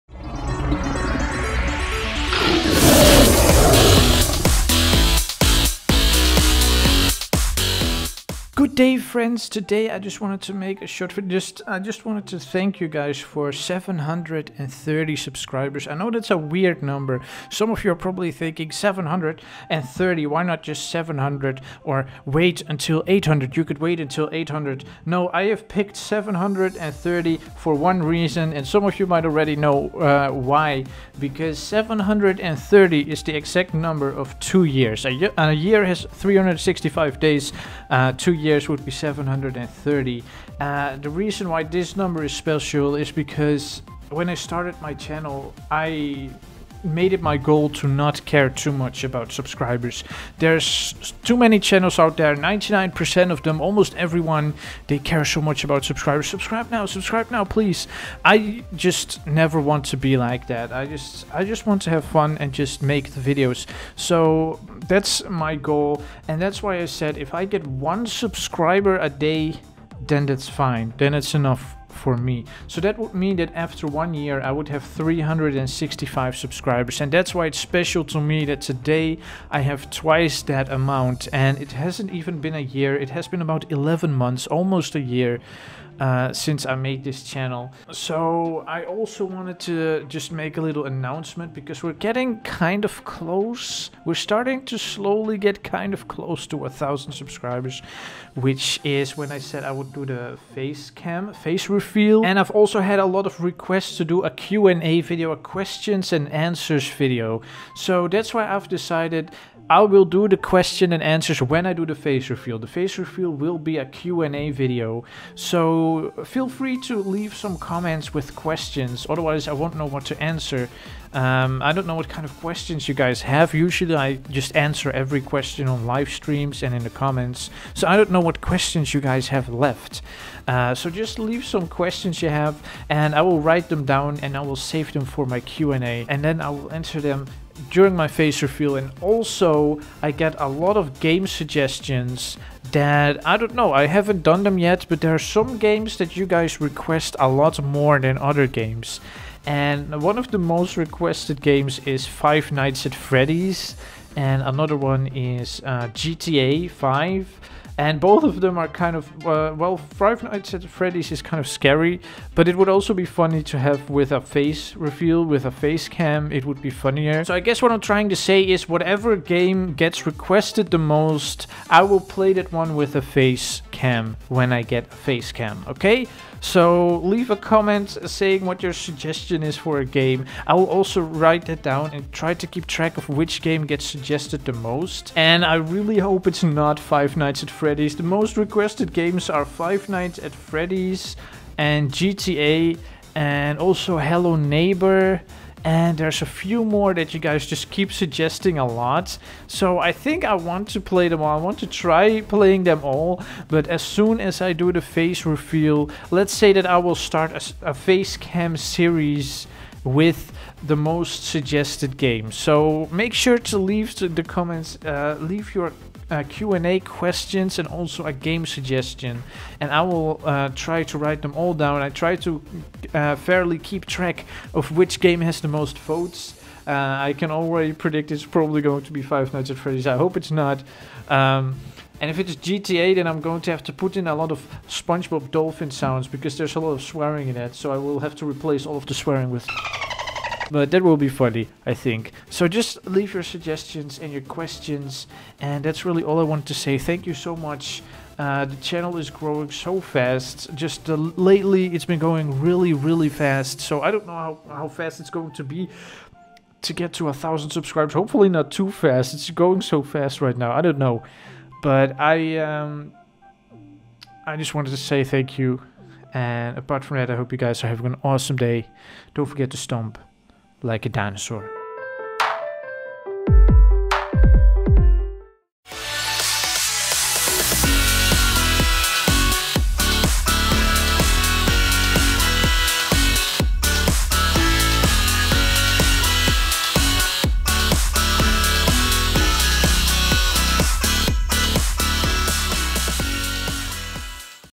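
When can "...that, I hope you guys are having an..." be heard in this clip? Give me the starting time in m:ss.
4:26.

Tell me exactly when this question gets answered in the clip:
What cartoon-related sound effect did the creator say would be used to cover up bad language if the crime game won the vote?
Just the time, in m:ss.
3:54.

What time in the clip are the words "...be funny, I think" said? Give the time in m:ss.
4:00.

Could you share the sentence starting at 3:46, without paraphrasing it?
Uh, I can already predict it's probably going to be Five Nights at Freddy's.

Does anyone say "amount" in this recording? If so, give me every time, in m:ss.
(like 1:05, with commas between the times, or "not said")
1:20.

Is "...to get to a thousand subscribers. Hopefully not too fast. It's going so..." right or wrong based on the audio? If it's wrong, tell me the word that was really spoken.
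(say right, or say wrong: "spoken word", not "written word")
right.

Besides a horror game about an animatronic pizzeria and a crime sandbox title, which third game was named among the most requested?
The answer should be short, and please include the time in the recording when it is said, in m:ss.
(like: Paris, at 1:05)
Hello Neighbor, at 3:13.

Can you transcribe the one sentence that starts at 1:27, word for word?
So I also wanted to just make a little announcement because we're getting kind of close.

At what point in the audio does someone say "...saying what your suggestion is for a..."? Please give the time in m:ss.
2:58.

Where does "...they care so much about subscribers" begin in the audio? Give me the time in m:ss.
0:54.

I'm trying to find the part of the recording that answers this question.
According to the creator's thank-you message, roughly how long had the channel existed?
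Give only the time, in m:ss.
1:23.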